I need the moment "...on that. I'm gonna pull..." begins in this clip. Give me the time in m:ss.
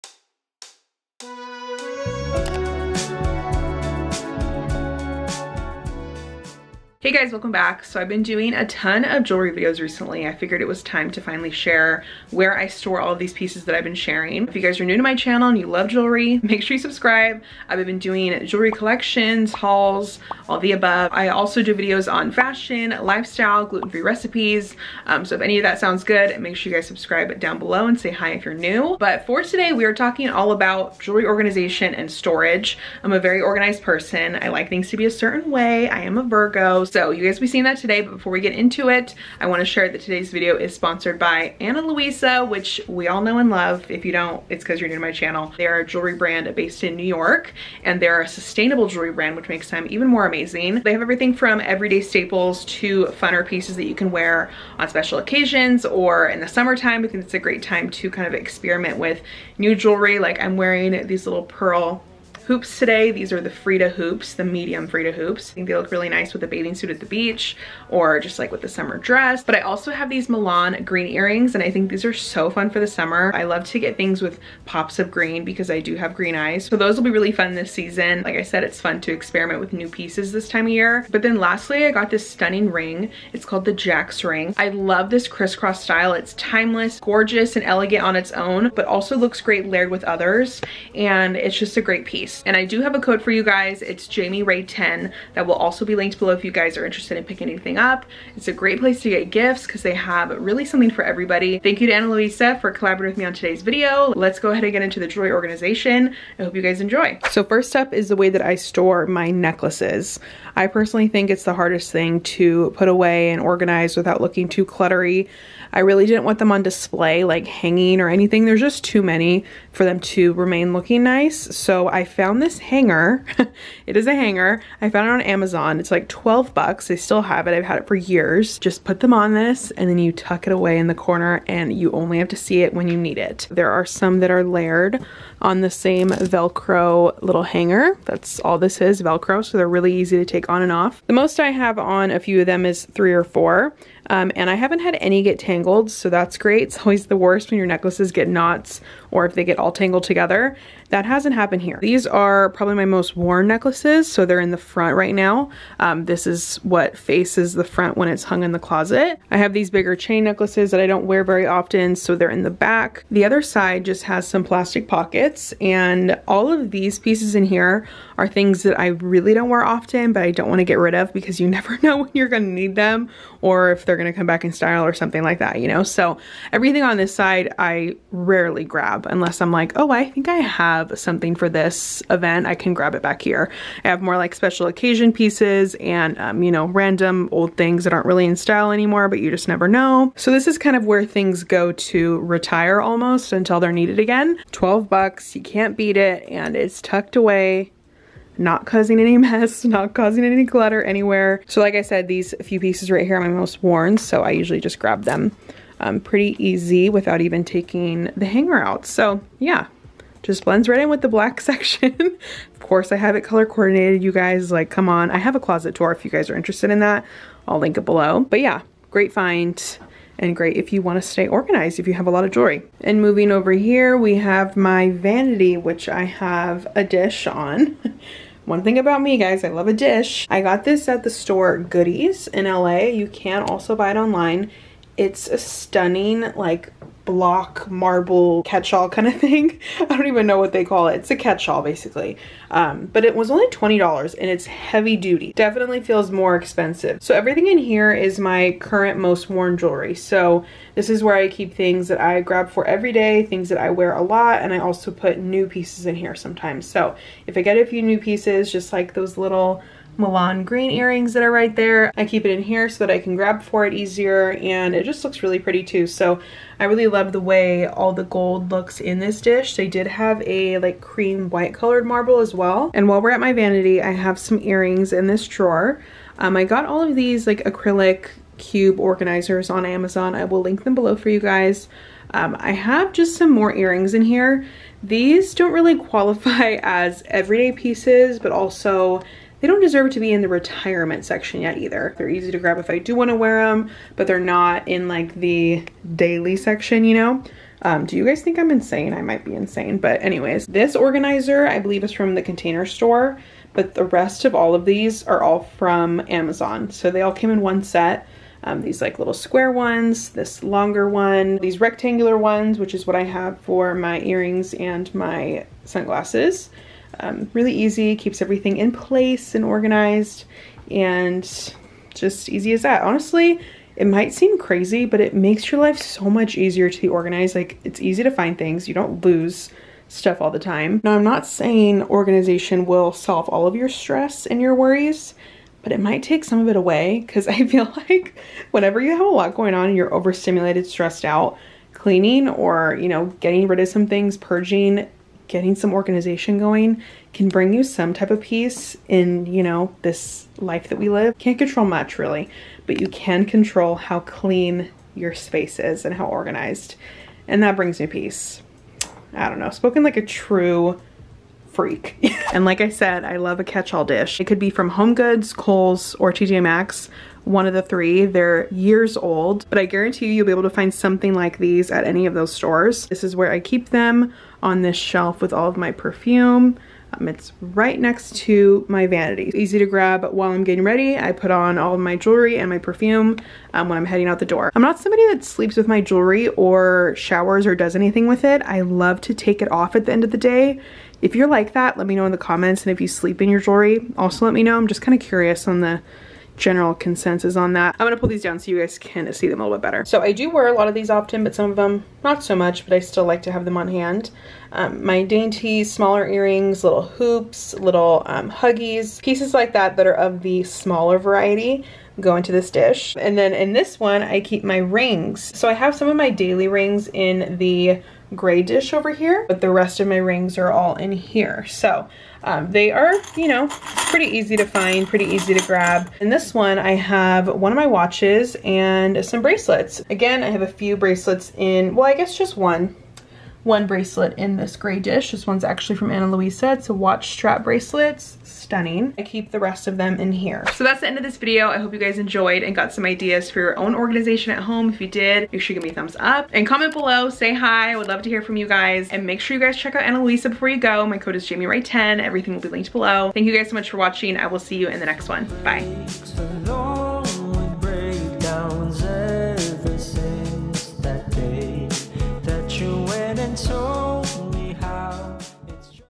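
6:37.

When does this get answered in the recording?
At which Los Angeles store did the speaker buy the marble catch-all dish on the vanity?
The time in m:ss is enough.
3:51.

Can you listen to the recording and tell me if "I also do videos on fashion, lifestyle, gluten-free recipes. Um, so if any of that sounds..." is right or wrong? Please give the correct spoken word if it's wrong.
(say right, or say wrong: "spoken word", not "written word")
right.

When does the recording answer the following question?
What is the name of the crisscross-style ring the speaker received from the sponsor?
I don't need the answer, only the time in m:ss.
1:23.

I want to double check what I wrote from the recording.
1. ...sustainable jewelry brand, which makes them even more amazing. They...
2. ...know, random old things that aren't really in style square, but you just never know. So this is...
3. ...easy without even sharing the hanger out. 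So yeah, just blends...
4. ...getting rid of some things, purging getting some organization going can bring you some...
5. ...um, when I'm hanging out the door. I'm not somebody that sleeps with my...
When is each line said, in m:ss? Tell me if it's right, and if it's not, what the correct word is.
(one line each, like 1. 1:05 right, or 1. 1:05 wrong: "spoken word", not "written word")
1. 0:48 right
2. 3:06 wrong: "anymore", not "square"
3. 3:26 wrong: "taking", not "sharing"
4. 5:43 right
5. 6:23 wrong: "heading", not "hanging".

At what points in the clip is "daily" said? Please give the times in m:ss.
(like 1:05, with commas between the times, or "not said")
4:55, 6:56.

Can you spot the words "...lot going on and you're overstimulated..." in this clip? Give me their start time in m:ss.
5:39.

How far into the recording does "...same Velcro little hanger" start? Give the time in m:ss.
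2:15.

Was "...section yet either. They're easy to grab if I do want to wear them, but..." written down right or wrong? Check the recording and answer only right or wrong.
right.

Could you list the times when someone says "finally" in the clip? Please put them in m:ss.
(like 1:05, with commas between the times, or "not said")
0:11.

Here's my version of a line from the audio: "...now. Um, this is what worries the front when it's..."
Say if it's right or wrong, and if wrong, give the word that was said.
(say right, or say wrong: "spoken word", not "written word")
wrong: "faces", not "worries".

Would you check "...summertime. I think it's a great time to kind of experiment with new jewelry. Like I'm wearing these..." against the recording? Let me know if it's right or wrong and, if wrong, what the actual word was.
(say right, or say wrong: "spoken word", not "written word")
right.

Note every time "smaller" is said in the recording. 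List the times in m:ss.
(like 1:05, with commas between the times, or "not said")
6:45, 6:50.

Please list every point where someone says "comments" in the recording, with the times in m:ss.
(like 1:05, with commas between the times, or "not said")
6:32, 7:26.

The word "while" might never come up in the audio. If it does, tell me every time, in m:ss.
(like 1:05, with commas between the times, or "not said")
4:32, 6:20.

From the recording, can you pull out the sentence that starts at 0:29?
But for today, we are talking all about jewelry organization and storage.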